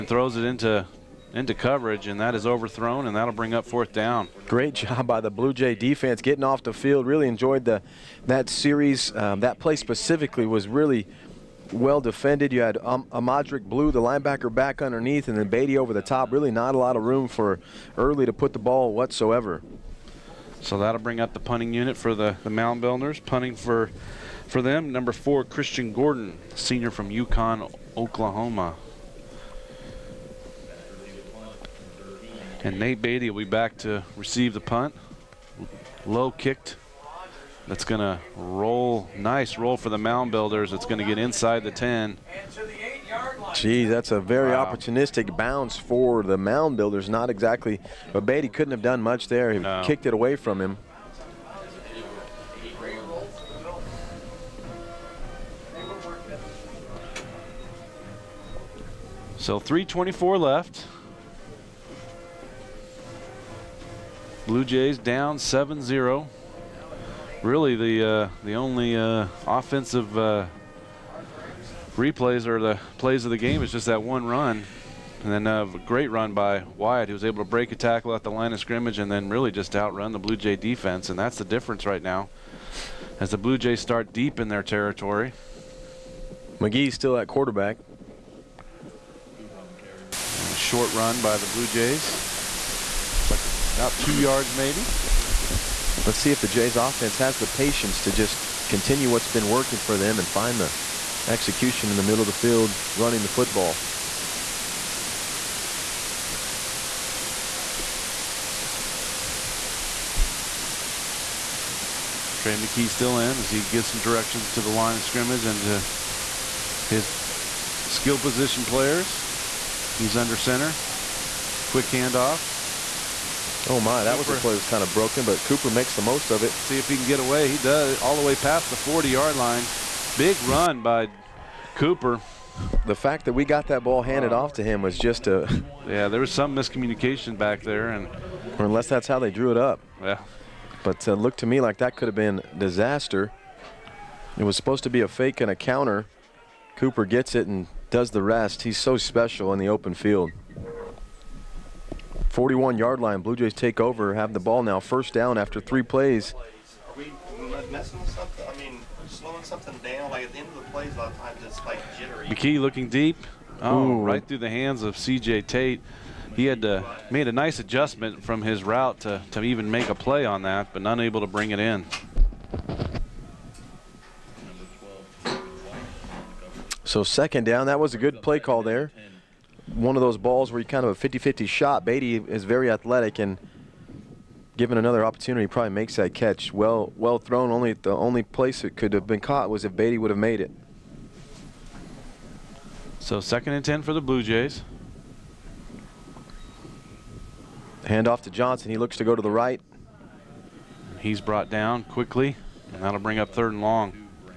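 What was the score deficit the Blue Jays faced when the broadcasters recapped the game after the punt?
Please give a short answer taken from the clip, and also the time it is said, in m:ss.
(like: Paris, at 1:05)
7-0, at 1:05.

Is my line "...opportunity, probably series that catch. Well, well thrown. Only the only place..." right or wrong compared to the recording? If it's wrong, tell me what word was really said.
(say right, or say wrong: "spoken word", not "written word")
wrong: "makes", not "series".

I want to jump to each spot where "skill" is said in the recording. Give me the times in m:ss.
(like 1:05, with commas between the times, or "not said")
1:57.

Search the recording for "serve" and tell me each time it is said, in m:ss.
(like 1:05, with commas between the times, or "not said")
not said.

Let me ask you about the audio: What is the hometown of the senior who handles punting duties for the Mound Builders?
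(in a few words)
Yukon, Oklahoma.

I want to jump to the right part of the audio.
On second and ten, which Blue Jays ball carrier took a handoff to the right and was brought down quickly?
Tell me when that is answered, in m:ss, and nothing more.
3:18.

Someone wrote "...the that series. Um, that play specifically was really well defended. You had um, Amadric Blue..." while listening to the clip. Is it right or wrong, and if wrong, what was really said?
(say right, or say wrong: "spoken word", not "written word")
right.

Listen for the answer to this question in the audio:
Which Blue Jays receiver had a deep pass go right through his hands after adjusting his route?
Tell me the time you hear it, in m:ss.
2:44.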